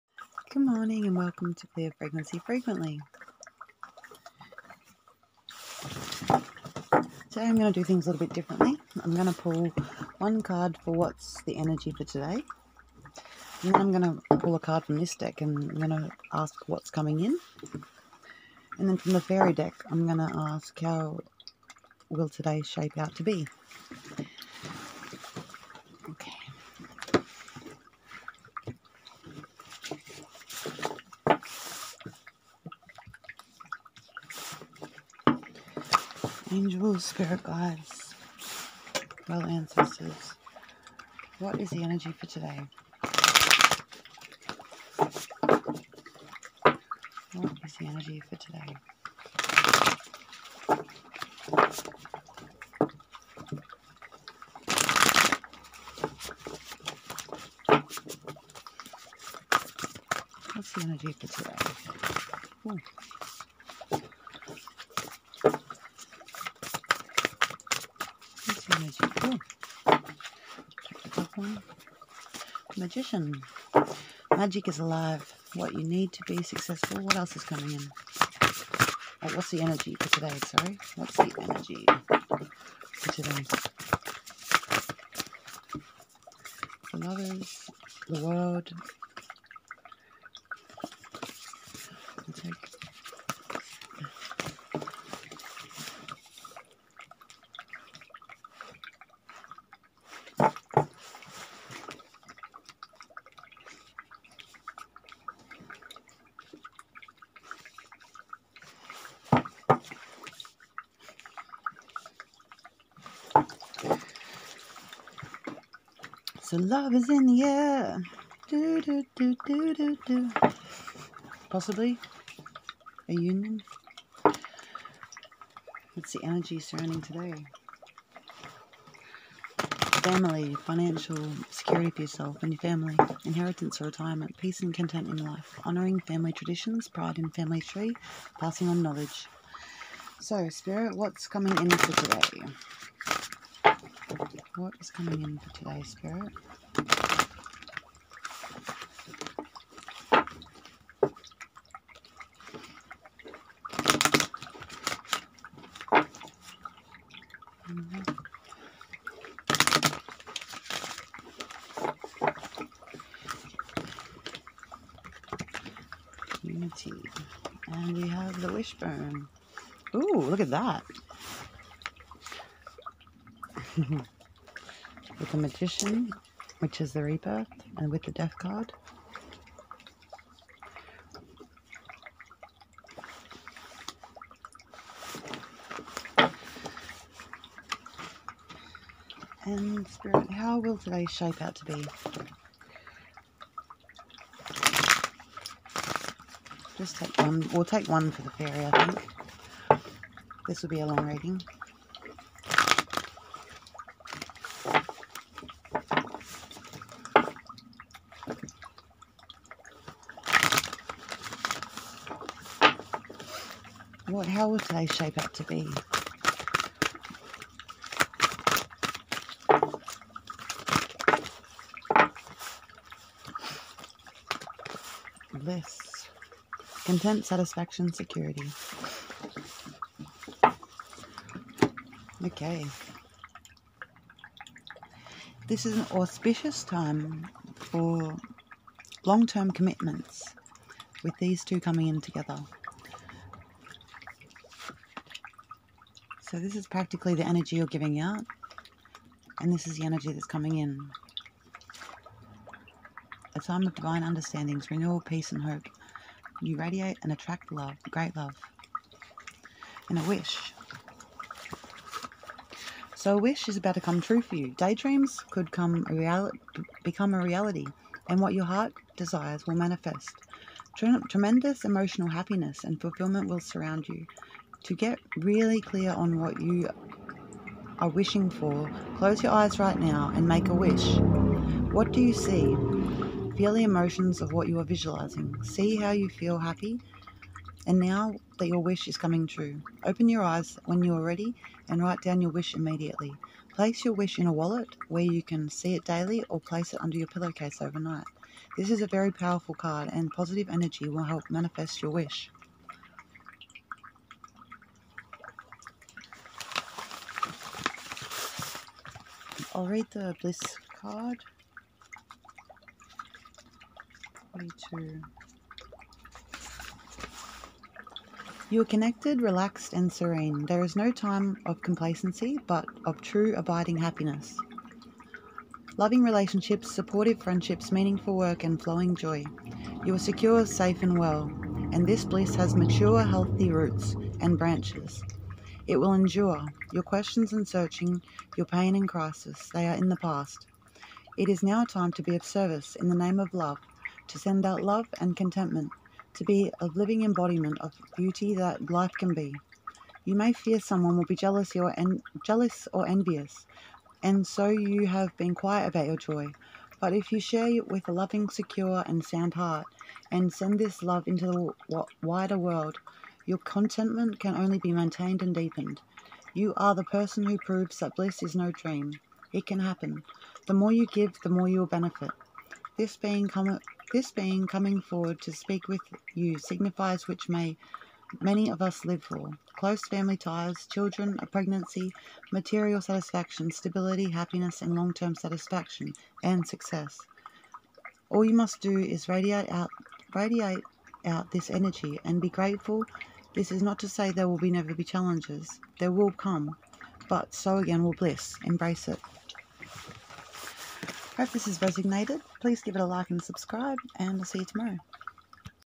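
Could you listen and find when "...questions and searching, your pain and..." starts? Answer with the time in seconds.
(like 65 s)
336 s.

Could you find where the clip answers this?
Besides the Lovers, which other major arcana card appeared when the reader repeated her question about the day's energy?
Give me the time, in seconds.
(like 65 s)
88 s.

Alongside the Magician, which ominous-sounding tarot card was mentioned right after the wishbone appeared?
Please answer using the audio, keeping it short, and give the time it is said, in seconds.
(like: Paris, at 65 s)
Death, at 178 s.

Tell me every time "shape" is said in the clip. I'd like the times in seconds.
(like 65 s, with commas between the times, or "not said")
22 s, 191 s, 214 s.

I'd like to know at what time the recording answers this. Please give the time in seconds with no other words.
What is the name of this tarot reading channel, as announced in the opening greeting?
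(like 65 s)
1 s.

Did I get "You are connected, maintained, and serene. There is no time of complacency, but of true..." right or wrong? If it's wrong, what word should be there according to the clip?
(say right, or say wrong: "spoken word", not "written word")
wrong: "relaxed", not "maintained".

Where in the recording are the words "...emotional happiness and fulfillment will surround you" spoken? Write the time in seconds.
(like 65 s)
271 s.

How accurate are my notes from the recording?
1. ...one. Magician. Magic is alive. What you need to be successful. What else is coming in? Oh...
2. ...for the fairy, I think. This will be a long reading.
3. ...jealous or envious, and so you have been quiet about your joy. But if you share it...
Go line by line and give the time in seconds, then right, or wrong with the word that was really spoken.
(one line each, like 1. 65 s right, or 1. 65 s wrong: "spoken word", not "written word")
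1. 71 s right
2. 198 s right
3. 352 s right.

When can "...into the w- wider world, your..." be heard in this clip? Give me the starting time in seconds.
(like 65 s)
361 s.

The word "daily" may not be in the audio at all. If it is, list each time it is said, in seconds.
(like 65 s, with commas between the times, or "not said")
295 s.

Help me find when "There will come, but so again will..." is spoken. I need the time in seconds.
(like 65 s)
395 s.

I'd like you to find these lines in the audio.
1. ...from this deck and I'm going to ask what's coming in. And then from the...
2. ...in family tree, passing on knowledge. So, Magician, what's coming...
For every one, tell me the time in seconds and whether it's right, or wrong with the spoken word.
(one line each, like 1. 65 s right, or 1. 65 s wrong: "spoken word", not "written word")
1. 14 s right
2. 137 s wrong: "Spirit", not "Magician".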